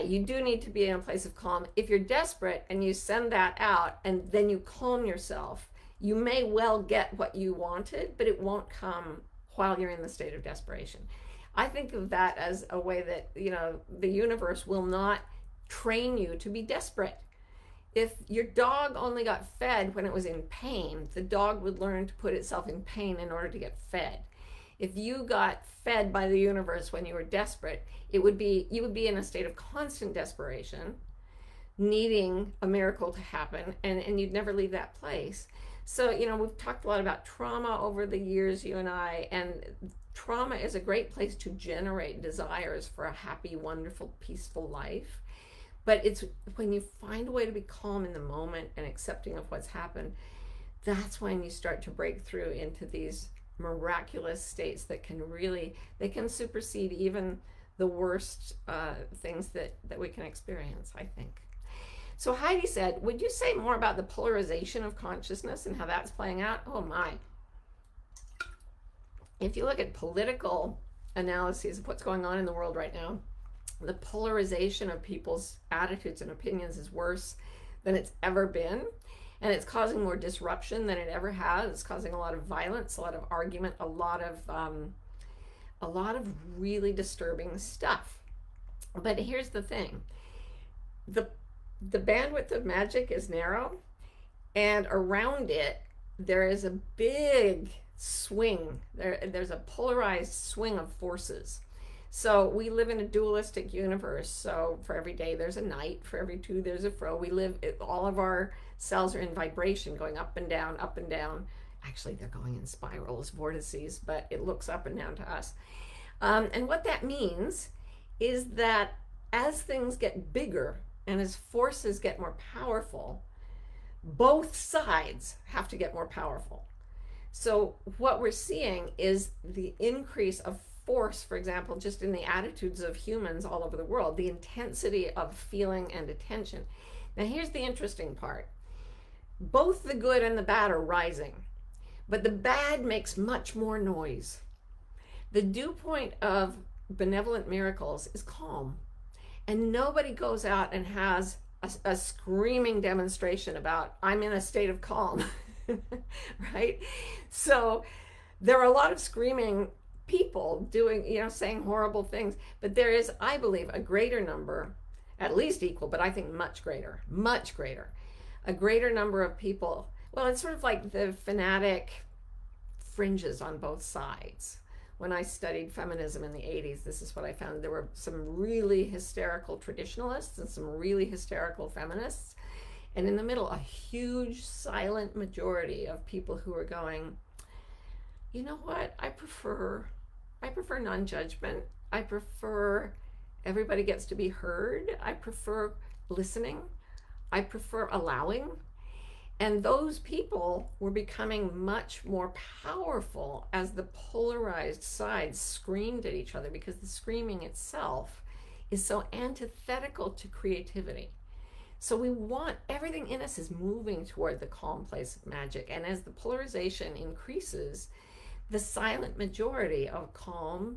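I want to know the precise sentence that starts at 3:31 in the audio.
So we want everything in us is moving toward the calm place of magic.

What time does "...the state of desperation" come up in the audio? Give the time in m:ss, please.
0:10.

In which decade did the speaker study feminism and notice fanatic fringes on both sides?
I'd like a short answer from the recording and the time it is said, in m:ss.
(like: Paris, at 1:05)
1980s, at 2:56.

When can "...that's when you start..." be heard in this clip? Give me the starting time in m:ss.
0:50.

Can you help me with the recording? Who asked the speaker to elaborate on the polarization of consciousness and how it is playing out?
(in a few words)
Heidi.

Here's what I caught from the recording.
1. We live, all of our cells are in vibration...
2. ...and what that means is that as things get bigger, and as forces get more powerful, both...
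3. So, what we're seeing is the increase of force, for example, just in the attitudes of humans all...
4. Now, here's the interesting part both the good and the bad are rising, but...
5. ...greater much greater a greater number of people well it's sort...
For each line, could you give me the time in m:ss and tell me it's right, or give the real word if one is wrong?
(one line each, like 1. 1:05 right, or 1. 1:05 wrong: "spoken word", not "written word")
1. 1:47 right
2. 1:56 right
3. 2:07 right
4. 2:17 right
5. 2:46 right.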